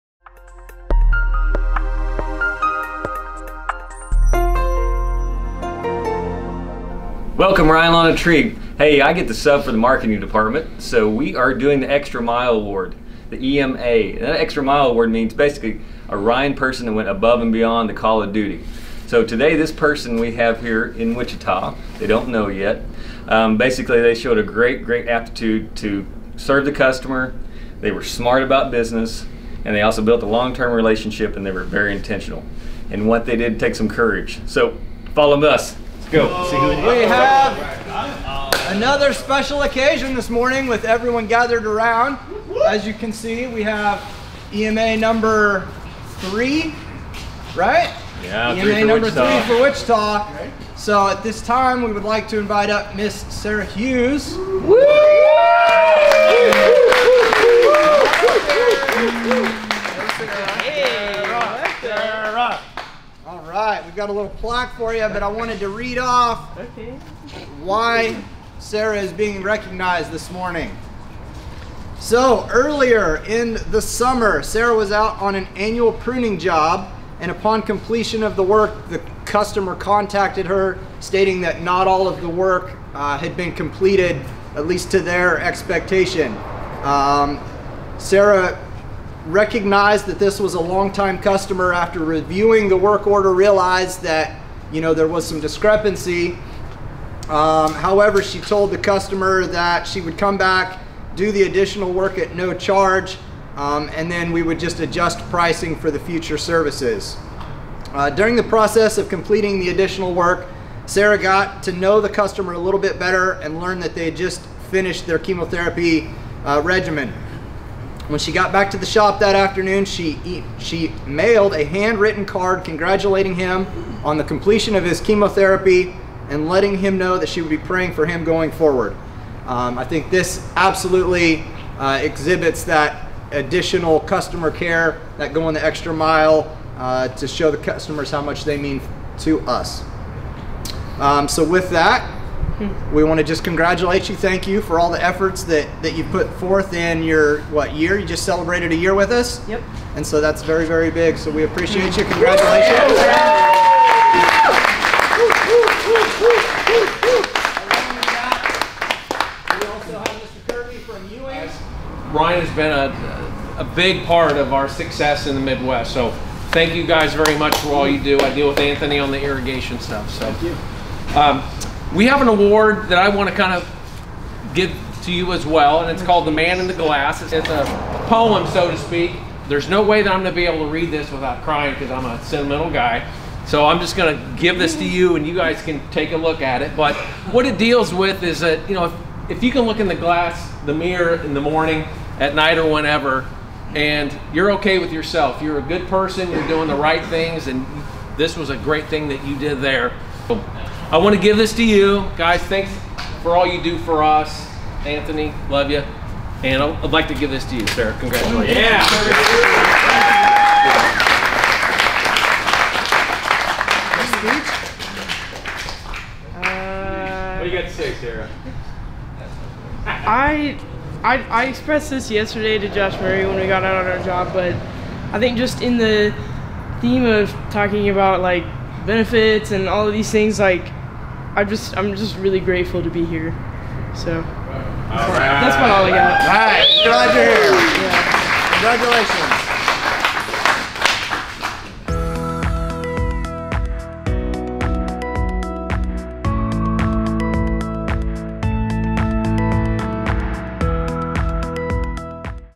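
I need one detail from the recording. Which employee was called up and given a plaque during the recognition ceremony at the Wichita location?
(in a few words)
Sarah Hughes.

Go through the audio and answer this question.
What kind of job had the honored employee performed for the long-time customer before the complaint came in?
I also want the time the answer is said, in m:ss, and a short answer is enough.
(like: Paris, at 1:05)
annual pruning, at 1:15.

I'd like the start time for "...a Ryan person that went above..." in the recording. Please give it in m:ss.
0:16.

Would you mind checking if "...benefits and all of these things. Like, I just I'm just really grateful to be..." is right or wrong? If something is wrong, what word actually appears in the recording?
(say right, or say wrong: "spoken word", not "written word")
right.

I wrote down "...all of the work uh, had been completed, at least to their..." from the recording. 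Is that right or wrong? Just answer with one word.
right.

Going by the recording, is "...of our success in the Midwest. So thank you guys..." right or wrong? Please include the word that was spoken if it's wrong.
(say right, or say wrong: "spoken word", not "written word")
right.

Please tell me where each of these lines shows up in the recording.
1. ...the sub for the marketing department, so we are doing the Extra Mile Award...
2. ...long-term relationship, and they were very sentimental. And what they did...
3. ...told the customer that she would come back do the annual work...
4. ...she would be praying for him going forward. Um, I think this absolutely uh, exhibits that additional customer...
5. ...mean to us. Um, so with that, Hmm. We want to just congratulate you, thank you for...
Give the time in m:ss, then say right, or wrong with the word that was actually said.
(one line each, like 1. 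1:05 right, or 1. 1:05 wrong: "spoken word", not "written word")
1. 0:09 right
2. 0:30 wrong: "intentional", not "sentimental"
3. 1:38 wrong: "additional", not "annual"
4. 2:07 right
5. 2:18 right.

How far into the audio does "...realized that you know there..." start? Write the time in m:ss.
1:33.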